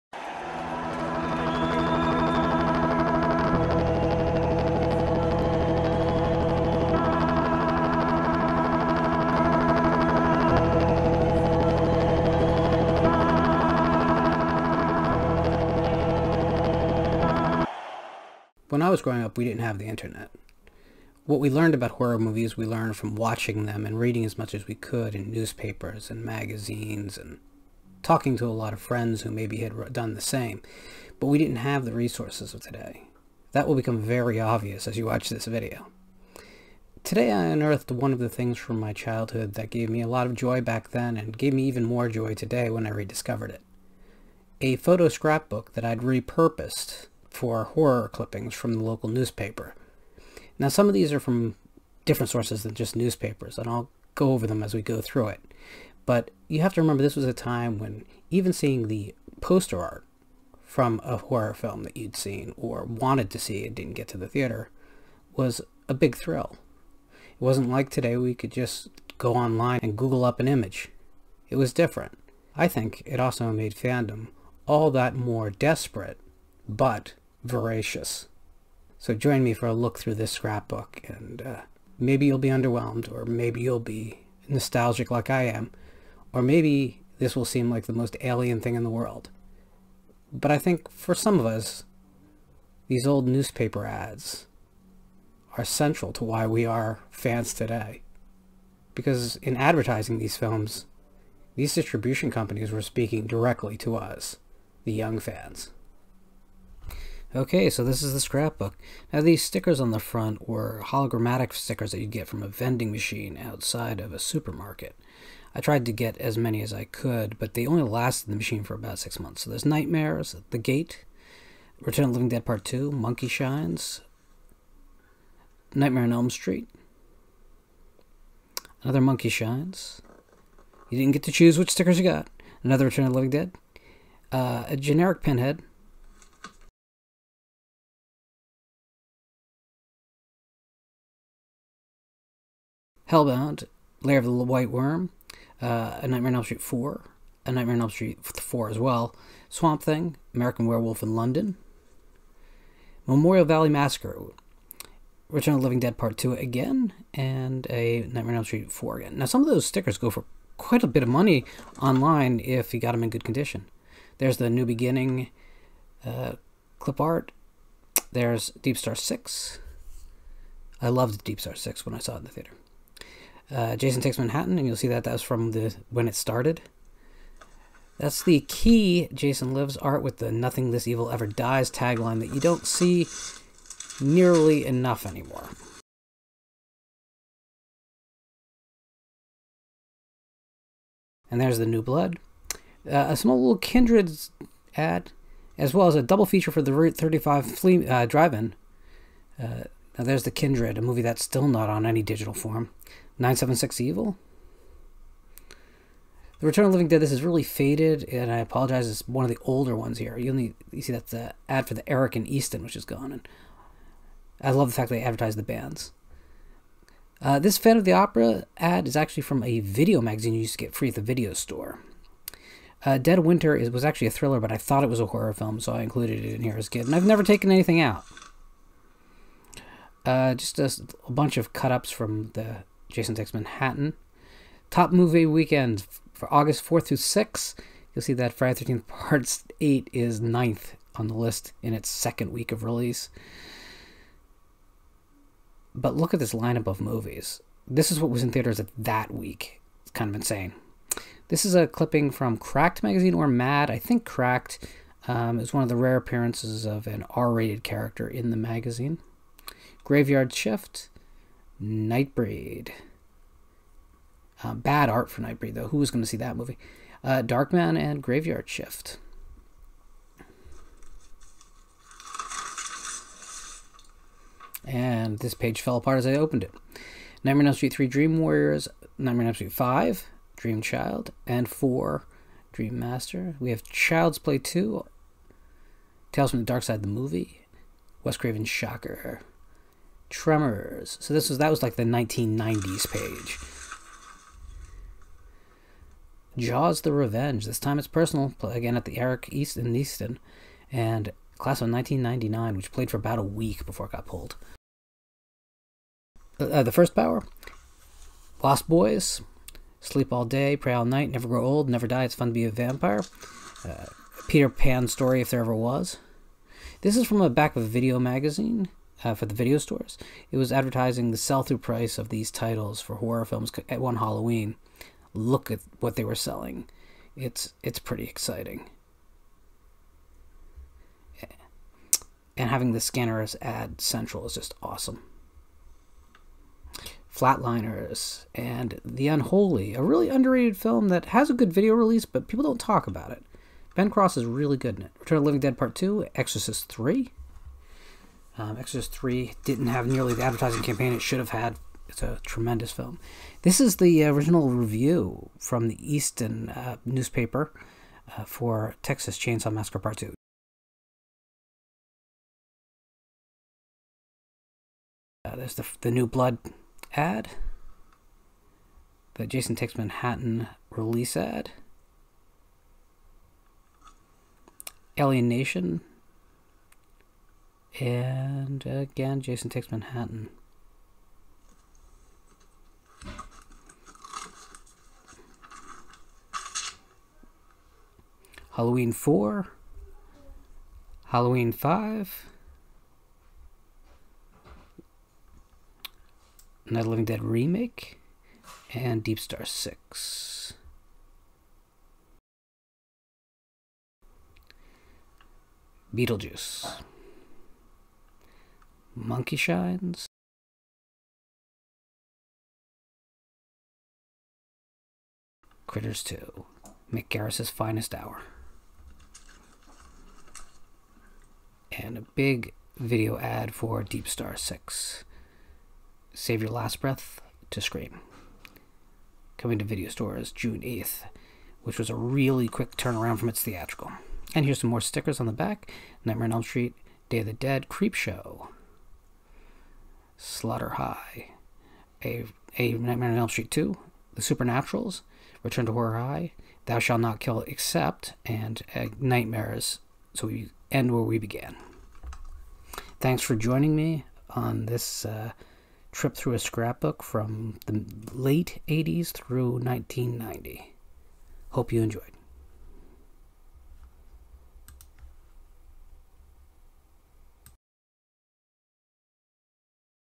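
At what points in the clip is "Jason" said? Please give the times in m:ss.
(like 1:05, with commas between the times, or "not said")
2:53, 2:59, 3:52, 6:09, 6:19.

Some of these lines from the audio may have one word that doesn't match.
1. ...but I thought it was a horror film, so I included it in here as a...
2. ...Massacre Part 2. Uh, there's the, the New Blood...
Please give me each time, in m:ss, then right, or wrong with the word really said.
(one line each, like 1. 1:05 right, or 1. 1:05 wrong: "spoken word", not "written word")
1. 3:44 right
2. 5:59 right.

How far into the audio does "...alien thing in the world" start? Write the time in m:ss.
1:28.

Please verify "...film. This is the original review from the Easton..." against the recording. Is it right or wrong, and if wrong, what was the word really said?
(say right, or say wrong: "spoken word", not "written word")
right.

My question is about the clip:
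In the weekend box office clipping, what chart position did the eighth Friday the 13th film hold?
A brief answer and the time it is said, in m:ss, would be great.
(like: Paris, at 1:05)
9th, at 4:00.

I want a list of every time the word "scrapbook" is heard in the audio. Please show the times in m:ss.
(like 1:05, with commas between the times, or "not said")
0:45, 1:20, 1:48, 7:36.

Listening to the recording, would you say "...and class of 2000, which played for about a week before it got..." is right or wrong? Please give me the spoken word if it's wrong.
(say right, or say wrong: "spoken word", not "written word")
wrong: "1999", not "2000".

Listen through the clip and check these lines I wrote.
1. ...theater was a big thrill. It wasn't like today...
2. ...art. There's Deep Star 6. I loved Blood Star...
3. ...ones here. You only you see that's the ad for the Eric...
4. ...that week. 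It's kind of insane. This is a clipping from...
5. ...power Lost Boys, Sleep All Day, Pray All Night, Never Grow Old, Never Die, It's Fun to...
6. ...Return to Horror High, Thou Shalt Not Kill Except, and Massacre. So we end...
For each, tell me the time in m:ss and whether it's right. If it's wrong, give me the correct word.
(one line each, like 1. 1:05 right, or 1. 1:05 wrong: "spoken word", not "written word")
1. 1:04 right
2. 2:47 wrong: "Deep", not "Blood"
3. 3:29 right
4. 4:08 right
5. 5:06 right
6. 7:25 wrong: "Nightmares", not "Massacre".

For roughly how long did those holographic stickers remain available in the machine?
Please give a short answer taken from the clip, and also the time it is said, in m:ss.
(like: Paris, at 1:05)
About six months, at 1:58.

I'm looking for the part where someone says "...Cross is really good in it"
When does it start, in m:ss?
5:43.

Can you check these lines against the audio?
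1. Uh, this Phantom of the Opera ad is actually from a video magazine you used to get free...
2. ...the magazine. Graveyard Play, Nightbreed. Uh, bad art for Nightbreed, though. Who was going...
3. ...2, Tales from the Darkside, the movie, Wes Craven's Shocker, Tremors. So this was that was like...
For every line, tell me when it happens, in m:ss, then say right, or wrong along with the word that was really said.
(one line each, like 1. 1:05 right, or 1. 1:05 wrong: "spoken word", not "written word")
1. 3:37 right
2. 4:18 wrong: "Shift", not "Play"
3. 4:44 right.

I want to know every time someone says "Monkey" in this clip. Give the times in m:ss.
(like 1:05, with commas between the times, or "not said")
2:02, 2:08, 6:48.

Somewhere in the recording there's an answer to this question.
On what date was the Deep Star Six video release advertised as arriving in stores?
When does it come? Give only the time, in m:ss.
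7:10.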